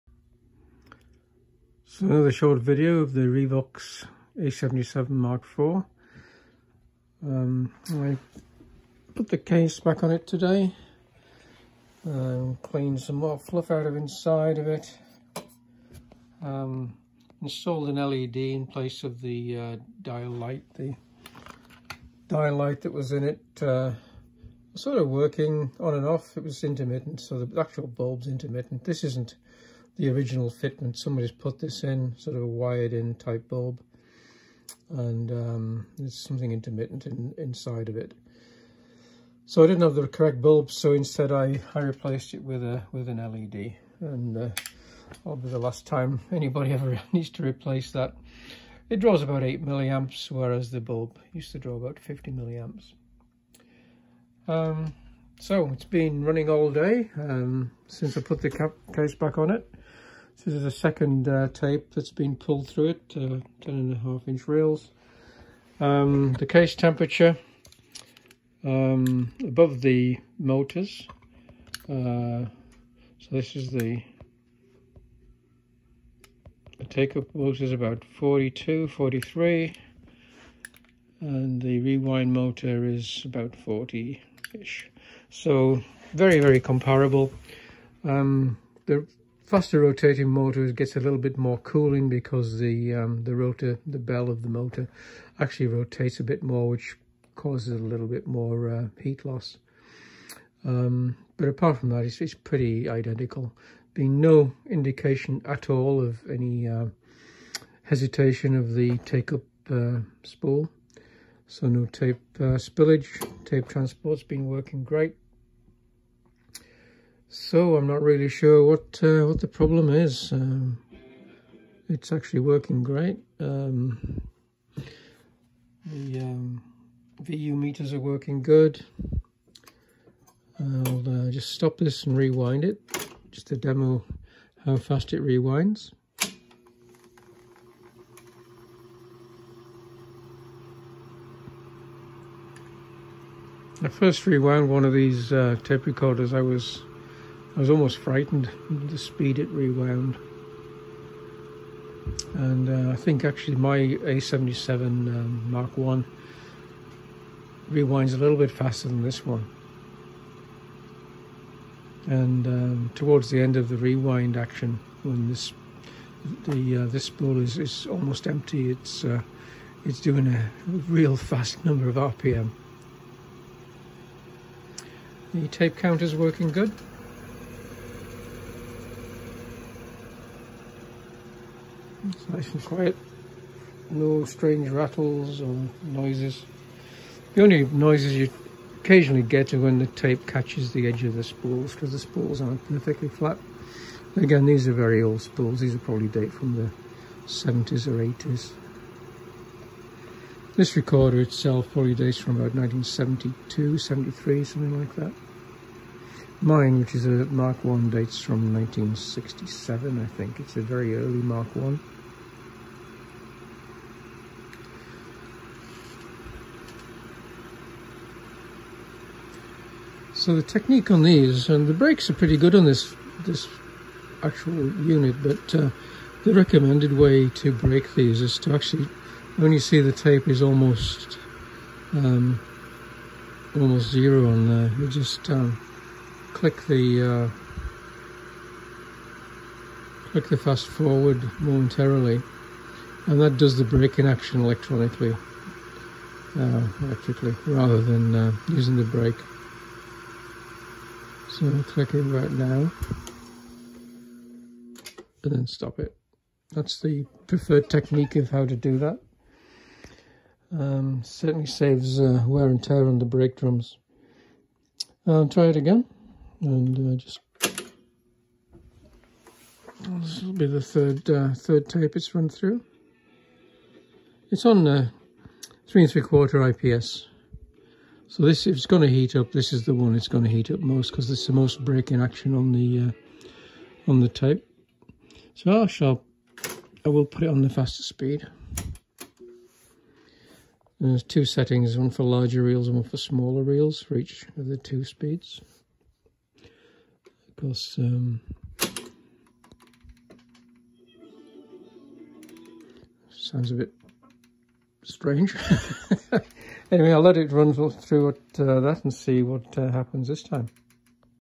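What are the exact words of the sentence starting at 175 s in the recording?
The tape counter is working good.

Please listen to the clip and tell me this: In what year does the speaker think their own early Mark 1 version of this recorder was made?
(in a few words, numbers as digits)
1967.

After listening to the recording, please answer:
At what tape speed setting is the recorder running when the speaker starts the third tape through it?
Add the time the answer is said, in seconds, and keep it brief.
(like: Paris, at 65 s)
3 3/4 IPS, at 275 s.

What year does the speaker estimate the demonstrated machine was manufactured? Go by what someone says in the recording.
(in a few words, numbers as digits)
1972.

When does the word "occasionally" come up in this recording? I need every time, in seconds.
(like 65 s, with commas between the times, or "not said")
188 s.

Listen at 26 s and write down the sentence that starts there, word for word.
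It was intermittent, so the actual bulb's intermittent.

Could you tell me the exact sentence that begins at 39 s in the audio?
So I didn't have the correct bulb, so instead I, I replaced it with a with an LED.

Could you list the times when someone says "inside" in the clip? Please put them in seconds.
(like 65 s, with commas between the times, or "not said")
13 s, 37 s.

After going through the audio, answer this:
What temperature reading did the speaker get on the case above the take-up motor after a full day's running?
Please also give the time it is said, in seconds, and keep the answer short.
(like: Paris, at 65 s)
42, at 78 s.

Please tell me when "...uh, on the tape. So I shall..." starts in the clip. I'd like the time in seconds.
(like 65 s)
282 s.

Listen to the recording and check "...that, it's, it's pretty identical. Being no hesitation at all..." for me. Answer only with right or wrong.
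wrong.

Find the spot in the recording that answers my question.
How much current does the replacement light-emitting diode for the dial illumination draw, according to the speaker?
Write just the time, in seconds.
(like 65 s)
49 s.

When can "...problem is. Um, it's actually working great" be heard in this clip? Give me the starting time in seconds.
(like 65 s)
119 s.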